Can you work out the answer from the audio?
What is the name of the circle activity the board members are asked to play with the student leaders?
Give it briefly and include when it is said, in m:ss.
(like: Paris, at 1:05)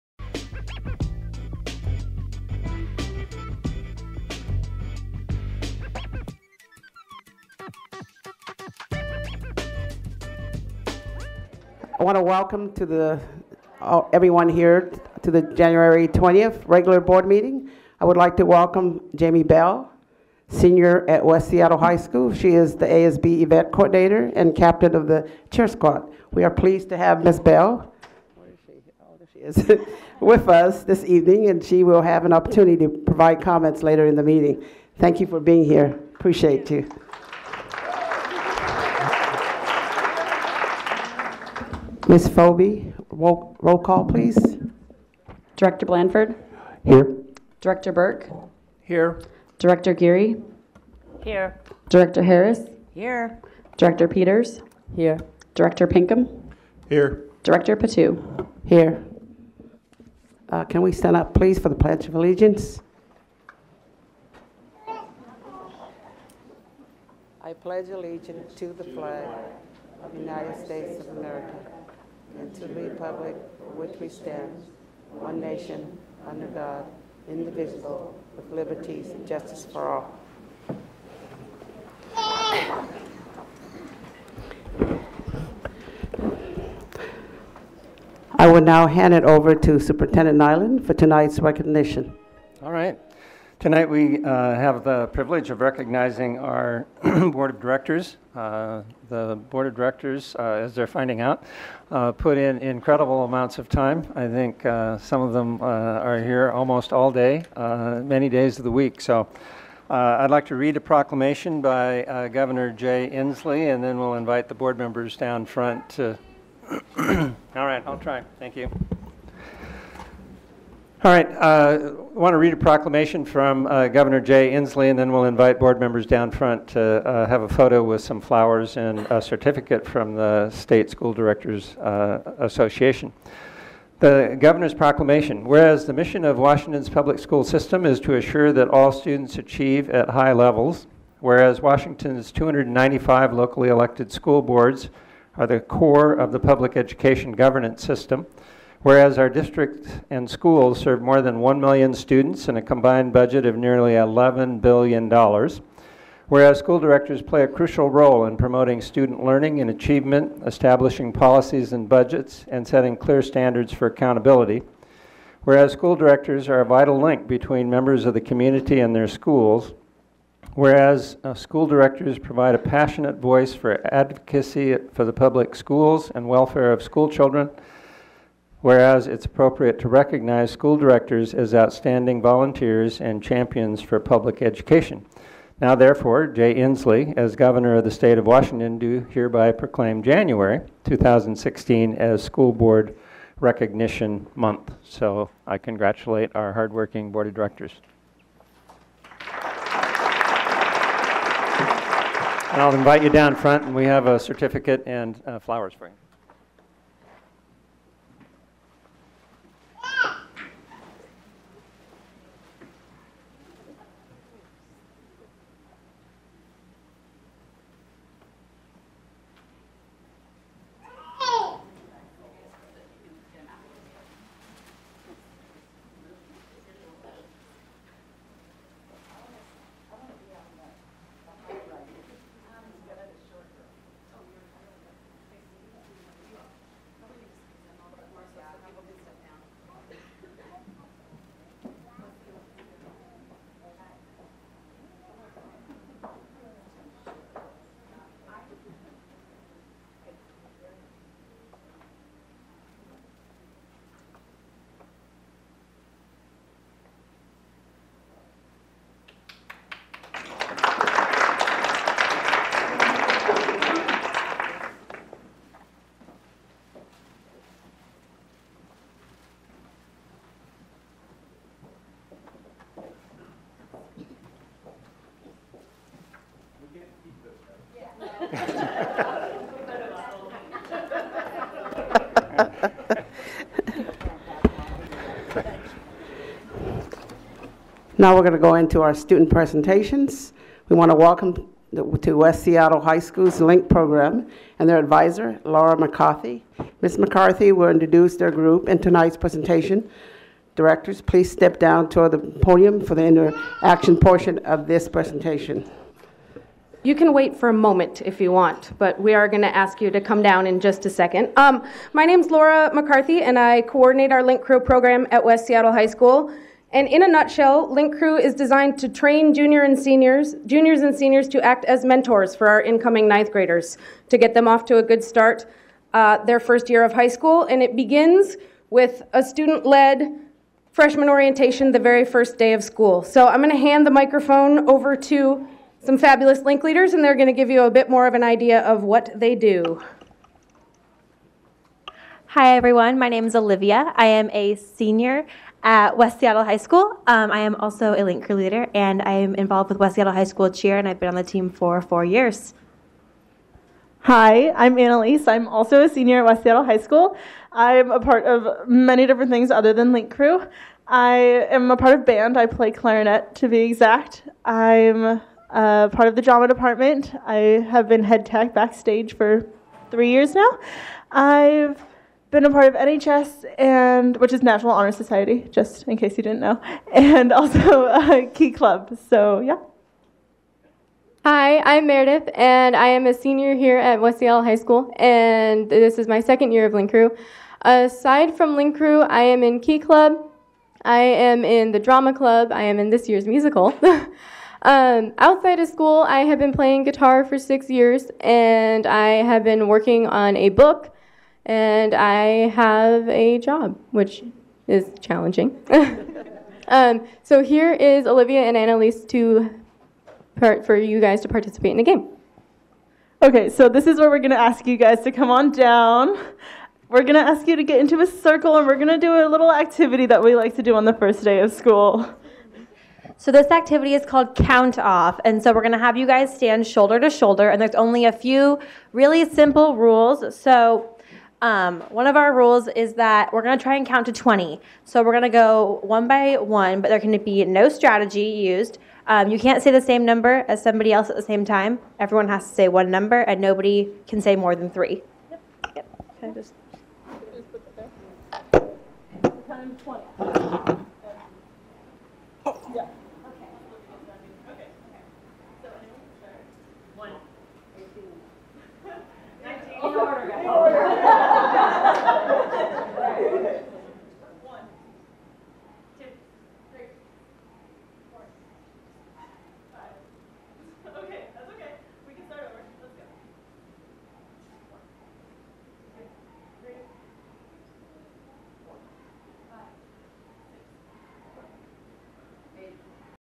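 count off, at 7:04.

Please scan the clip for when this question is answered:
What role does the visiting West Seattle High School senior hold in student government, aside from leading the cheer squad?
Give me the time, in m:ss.
0:22.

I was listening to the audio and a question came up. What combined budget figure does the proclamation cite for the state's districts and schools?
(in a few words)
nearly $11 billion.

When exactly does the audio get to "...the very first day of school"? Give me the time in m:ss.
5:31.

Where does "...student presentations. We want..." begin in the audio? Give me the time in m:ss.
4:48.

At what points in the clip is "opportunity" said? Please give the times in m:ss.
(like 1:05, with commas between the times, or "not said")
0:32.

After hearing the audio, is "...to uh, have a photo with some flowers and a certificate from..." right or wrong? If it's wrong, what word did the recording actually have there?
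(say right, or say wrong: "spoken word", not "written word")
right.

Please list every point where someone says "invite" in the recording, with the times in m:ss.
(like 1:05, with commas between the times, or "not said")
1:54, 2:05, 3:22.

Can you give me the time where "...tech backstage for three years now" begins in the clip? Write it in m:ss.
6:08.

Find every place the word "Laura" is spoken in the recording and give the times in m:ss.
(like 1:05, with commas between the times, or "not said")
4:55, 5:12.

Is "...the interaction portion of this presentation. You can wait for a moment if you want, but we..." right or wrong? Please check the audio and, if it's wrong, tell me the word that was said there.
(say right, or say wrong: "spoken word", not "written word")
right.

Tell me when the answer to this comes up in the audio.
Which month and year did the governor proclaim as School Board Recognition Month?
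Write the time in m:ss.
3:10.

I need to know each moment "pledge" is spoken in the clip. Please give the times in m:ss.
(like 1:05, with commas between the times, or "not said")
1:01, 1:07.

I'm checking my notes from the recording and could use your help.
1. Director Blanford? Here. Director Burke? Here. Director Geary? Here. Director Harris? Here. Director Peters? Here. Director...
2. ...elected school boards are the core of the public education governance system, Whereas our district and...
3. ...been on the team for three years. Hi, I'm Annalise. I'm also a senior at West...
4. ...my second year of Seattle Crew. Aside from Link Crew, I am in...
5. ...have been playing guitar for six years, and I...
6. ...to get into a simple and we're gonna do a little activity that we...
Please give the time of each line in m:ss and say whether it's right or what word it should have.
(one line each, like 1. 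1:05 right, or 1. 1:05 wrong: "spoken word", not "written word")
1. 0:45 right
2. 2:23 right
3. 5:50 wrong: "four", not "three"
4. 6:26 wrong: "Link", not "Seattle"
5. 6:36 right
6. 6:57 wrong: "circle", not "simple".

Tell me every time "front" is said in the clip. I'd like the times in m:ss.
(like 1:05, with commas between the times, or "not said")
1:55, 2:06, 3:23.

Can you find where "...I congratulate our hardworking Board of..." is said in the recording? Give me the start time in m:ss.
3:15.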